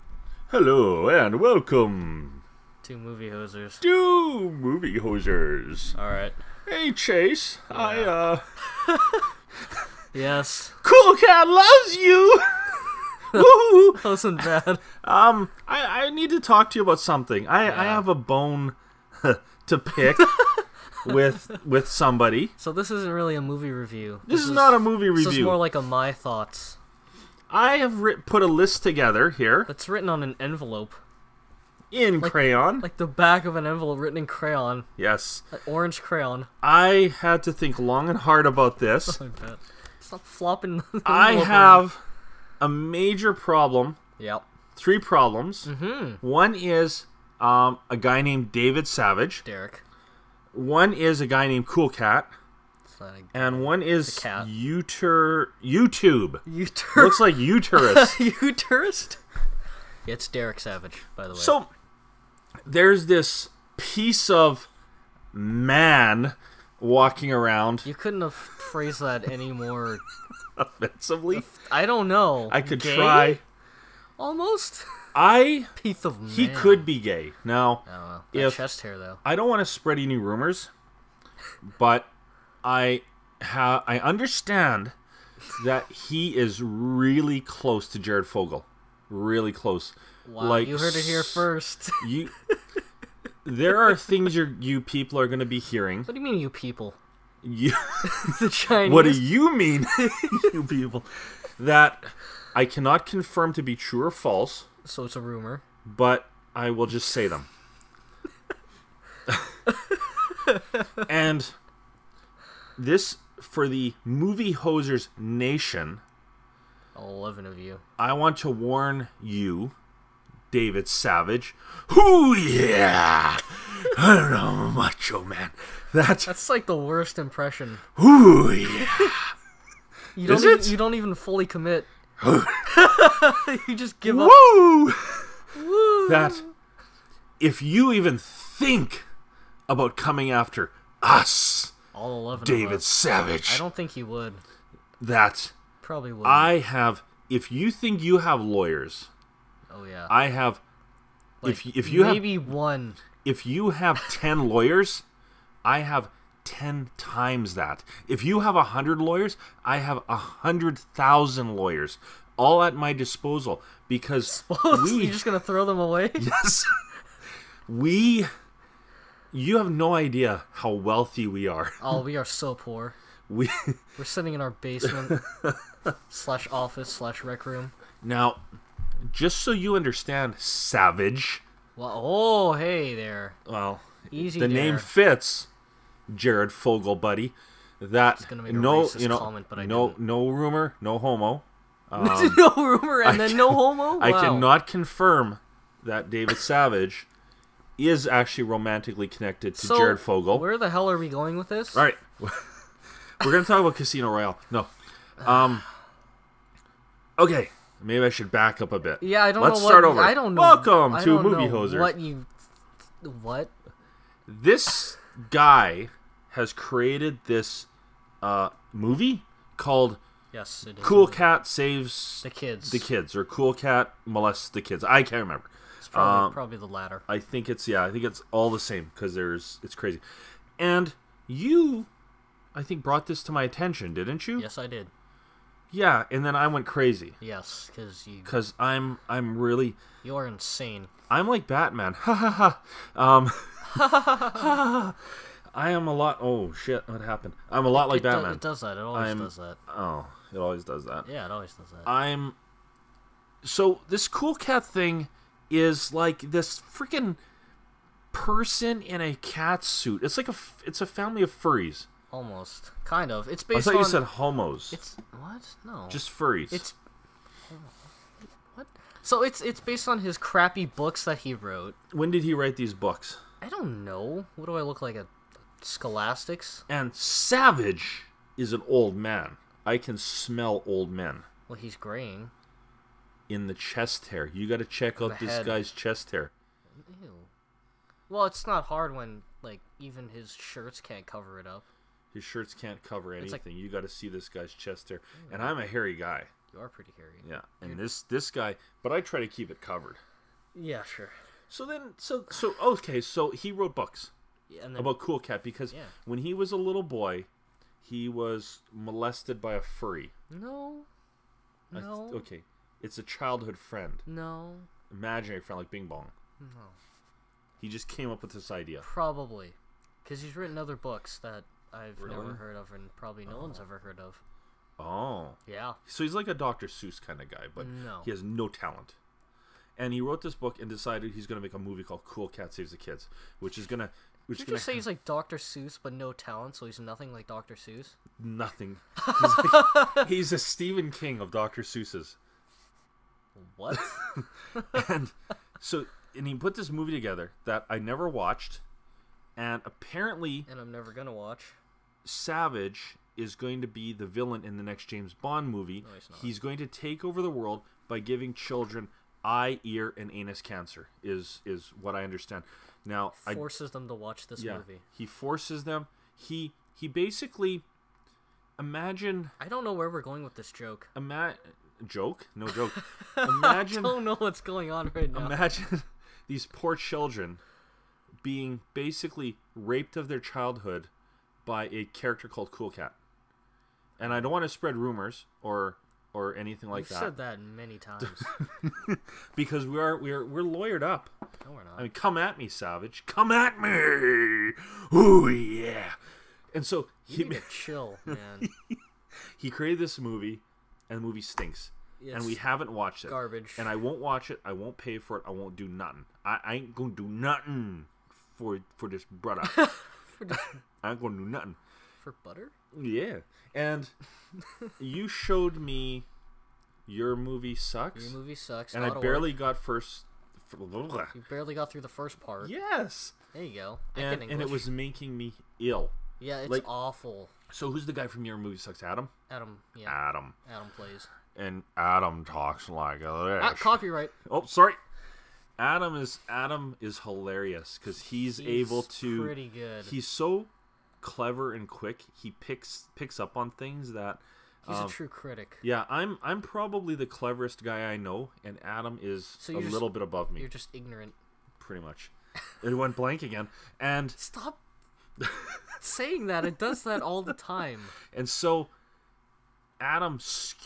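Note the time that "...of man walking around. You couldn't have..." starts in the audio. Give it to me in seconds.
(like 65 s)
64 s.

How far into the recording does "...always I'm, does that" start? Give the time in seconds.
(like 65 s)
248 s.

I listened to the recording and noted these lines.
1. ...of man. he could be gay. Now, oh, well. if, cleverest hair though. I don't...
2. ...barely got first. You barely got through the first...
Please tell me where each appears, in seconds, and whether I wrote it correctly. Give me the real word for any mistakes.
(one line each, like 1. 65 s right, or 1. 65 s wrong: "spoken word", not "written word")
1. 76 s wrong: "chest", not "cleverest"
2. 418 s right.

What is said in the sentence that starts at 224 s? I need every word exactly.
I can't remember probably, um, probably the latter.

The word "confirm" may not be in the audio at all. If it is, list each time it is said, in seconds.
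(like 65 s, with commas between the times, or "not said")
103 s, 194 s.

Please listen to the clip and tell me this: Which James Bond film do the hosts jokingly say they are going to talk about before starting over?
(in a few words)
Casino Royale.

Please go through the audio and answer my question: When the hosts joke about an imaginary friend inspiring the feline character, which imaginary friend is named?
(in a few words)
Bing Bong.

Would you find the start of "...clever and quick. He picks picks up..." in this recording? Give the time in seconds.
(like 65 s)
441 s.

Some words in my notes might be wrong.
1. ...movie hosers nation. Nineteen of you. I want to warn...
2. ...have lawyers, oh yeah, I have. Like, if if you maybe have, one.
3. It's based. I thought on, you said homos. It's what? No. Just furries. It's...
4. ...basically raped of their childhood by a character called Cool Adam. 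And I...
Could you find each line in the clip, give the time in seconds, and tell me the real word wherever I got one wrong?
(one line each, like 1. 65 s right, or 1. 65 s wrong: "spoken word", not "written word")
1. 114 s wrong: "Eleven", not "Nineteen"
2. 148 s right
3. 263 s right
4. 378 s wrong: "Cat", not "Adam".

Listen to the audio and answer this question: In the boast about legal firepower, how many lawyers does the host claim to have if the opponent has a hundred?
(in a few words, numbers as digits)
100,000.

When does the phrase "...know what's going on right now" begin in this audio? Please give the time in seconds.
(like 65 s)
374 s.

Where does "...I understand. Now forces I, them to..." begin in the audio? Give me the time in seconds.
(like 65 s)
361 s.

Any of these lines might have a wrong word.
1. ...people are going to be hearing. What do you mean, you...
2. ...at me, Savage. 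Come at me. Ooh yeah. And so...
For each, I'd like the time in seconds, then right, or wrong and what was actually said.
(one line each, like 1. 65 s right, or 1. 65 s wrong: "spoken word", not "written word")
1. 94 s right
2. 392 s right.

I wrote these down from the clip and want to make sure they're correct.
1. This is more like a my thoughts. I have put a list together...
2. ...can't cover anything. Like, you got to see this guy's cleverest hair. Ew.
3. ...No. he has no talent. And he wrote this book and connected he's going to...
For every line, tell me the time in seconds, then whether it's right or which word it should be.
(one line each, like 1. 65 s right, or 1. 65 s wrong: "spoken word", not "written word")
1. 25 s right
2. 292 s wrong: "chest", not "cleverest"
3. 327 s wrong: "decided", not "connected".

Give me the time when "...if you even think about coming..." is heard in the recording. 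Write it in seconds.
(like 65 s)
137 s.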